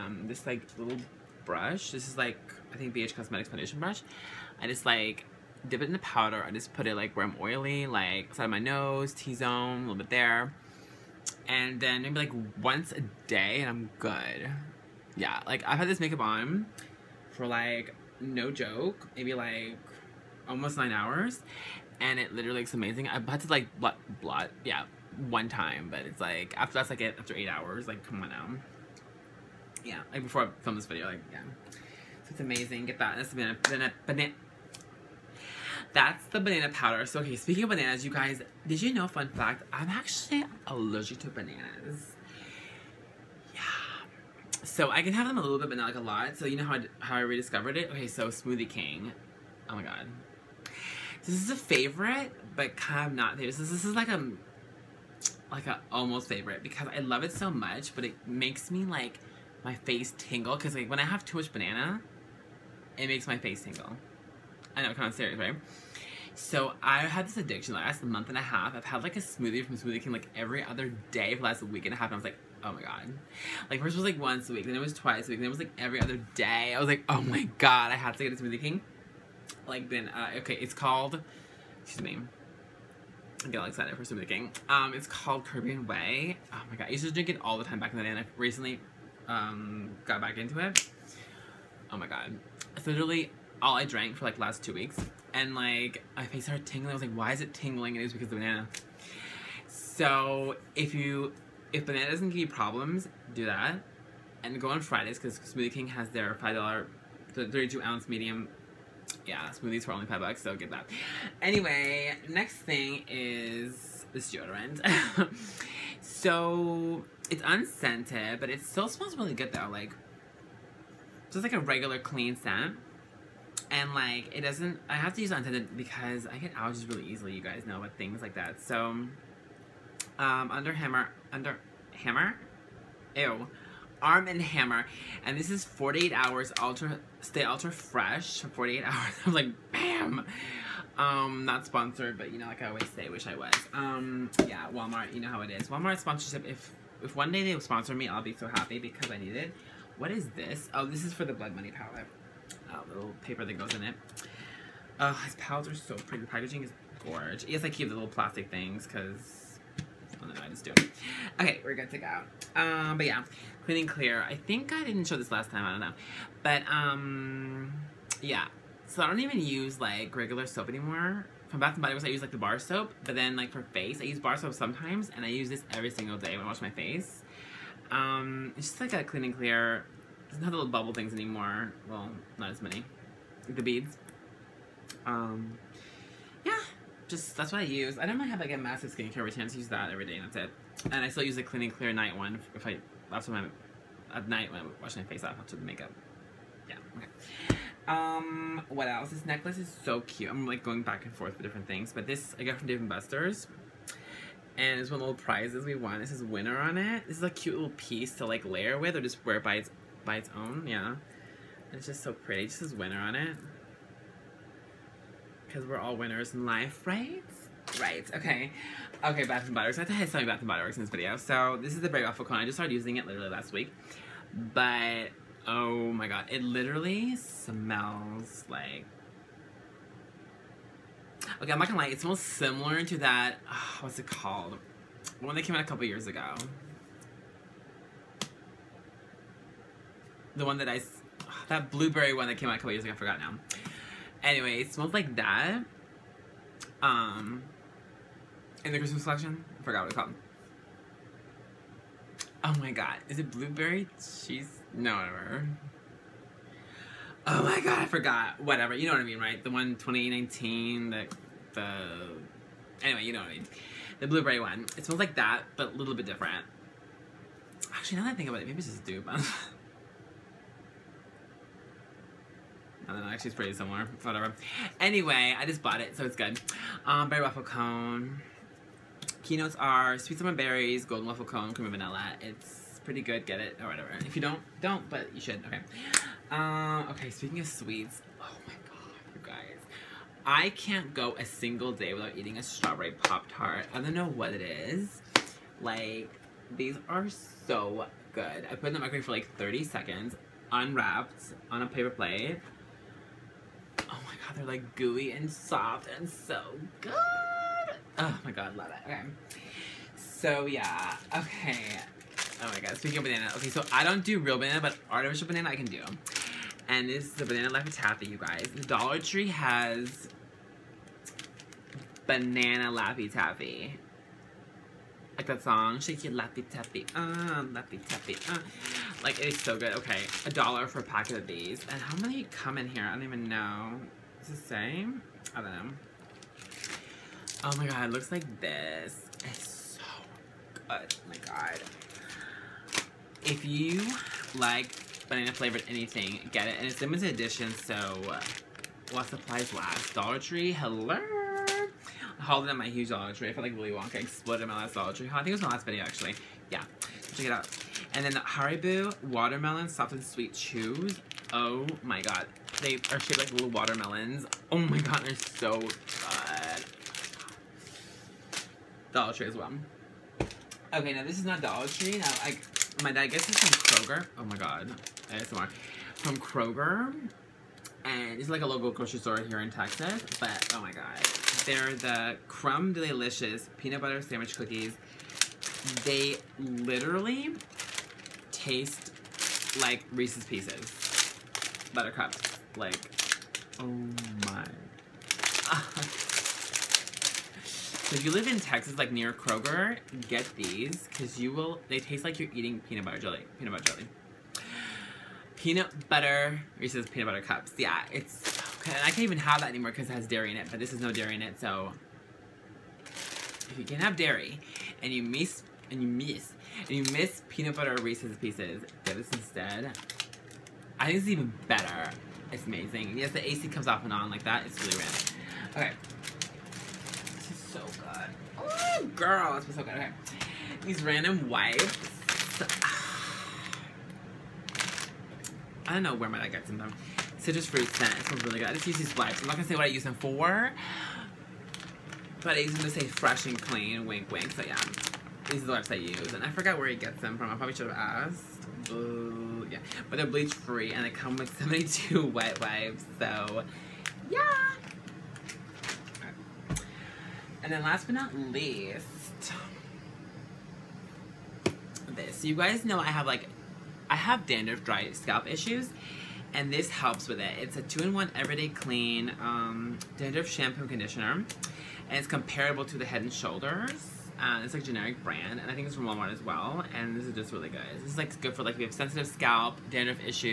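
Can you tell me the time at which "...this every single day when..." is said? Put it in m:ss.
2:55.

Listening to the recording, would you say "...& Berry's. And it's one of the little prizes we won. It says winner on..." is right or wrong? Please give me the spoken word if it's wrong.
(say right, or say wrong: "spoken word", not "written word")
wrong: "Buster", not "Berry".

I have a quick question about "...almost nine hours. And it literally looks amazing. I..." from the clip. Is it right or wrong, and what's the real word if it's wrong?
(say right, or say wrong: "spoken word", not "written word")
right.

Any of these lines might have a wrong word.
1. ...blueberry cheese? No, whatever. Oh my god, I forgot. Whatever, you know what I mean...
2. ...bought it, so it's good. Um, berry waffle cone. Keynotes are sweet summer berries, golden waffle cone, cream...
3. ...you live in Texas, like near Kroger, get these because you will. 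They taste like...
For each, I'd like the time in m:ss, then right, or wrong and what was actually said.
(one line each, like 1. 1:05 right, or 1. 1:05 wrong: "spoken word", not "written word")
1. 4:13 right
2. 4:35 right
3. 6:38 right.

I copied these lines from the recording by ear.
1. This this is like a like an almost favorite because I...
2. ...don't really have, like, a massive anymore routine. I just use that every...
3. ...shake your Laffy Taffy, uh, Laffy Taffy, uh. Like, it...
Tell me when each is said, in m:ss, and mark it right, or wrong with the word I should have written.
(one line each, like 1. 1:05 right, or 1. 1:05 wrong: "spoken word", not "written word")
1. 0:53 right
2. 3:08 wrong: "skincare", not "anymore"
3. 5:25 right.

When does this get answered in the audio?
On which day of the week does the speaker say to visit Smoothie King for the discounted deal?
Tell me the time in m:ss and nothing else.
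1:44.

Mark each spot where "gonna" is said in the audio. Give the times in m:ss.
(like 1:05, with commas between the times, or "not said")
3:51.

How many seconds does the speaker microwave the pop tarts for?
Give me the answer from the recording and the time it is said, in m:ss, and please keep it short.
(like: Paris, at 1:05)
30, at 4:59.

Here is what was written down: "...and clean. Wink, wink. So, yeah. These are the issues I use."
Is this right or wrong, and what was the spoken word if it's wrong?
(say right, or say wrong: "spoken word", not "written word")
wrong: "wipes", not "issues".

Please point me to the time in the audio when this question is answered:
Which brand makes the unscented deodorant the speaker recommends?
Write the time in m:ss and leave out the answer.
2:14.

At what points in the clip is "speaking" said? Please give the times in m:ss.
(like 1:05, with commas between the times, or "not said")
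0:37, 4:47, 5:12.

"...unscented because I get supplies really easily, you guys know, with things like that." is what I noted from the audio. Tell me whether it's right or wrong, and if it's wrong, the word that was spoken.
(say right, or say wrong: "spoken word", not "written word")
wrong: "allergies", not "supplies".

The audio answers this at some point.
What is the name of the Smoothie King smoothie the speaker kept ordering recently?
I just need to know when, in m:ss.
1:25.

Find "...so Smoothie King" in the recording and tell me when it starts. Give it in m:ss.
0:48.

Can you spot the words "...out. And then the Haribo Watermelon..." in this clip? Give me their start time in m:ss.
5:57.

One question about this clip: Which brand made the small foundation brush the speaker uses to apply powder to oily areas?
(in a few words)
BH Cosmetics.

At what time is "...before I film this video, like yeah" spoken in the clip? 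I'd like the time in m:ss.
0:30.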